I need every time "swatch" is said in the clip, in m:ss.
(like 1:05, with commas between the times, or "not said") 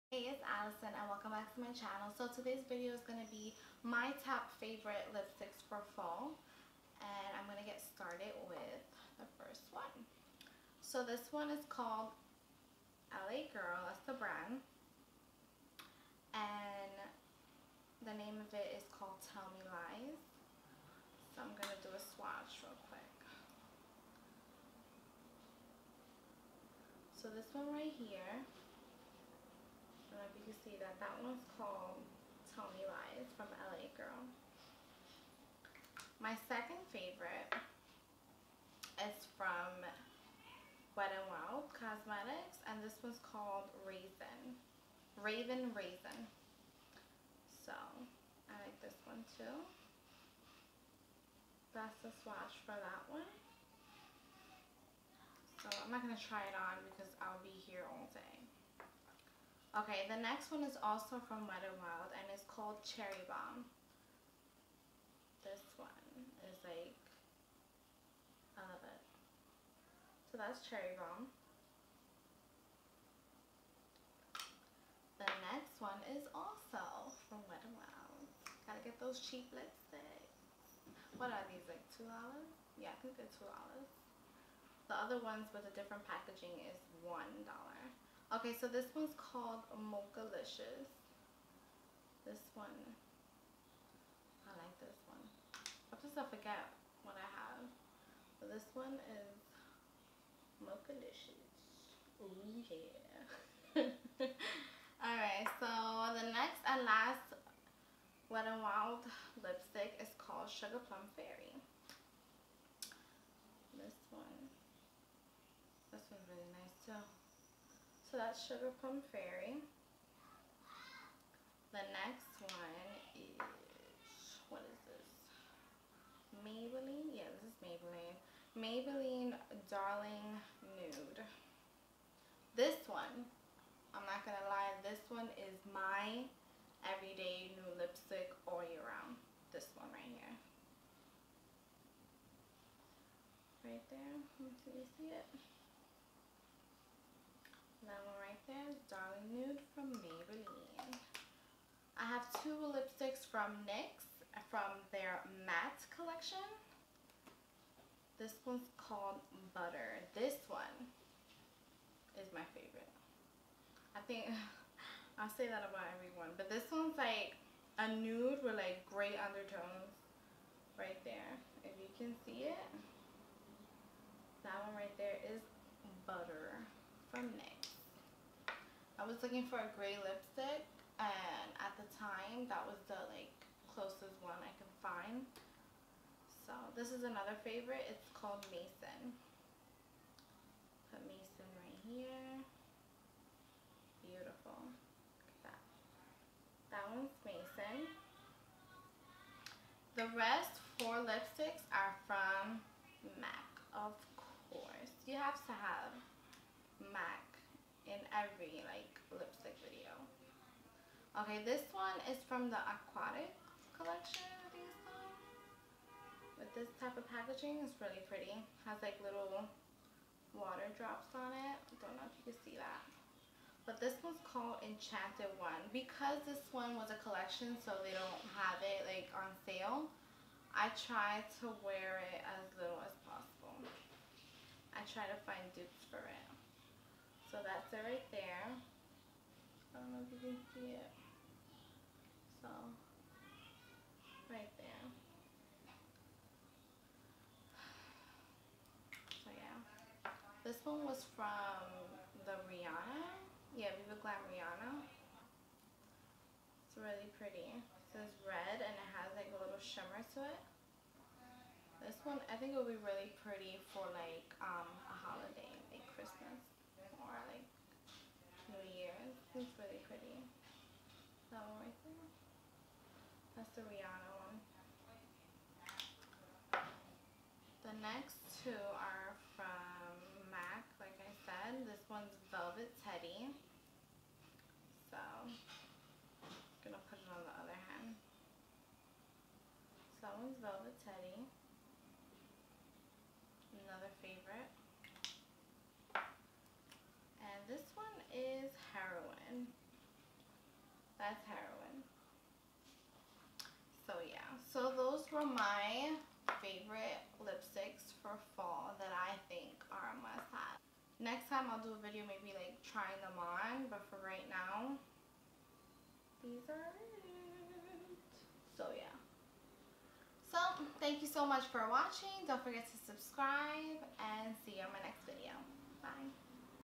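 0:22, 0:52.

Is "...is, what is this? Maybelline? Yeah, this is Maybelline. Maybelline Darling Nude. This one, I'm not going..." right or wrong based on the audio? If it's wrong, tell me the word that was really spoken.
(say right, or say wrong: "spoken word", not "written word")
right.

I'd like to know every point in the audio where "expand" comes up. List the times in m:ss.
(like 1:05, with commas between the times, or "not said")
not said.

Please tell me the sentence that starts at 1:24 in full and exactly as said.
The other ones with a different packaging is $1.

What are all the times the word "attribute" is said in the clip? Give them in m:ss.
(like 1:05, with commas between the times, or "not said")
not said.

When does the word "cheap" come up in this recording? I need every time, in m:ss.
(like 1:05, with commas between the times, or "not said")
1:19.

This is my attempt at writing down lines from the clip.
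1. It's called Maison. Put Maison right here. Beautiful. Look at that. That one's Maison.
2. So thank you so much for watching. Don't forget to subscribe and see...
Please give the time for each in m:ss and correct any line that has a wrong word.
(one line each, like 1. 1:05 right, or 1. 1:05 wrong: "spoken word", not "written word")
1. 3:07 right
2. 5:20 right.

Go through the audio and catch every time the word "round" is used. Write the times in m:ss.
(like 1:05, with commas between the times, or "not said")
2:18.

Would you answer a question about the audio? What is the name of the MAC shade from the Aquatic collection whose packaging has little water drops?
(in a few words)
Enchanted One.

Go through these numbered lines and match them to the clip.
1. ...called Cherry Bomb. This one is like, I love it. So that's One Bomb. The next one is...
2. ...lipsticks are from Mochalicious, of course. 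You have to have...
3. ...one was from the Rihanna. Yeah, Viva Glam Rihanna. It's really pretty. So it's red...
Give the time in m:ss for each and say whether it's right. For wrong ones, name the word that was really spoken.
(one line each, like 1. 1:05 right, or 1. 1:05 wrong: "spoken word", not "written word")
1. 1:02 wrong: "Cherry", not "One"
2. 3:21 wrong: "MAC", not "Mochalicious"
3. 4:10 right.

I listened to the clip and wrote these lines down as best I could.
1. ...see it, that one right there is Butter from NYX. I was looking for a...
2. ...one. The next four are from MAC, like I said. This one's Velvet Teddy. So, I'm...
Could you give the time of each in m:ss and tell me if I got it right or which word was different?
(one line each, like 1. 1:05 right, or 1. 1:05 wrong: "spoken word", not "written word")
1. 2:52 right
2. 4:34 wrong: "two", not "four".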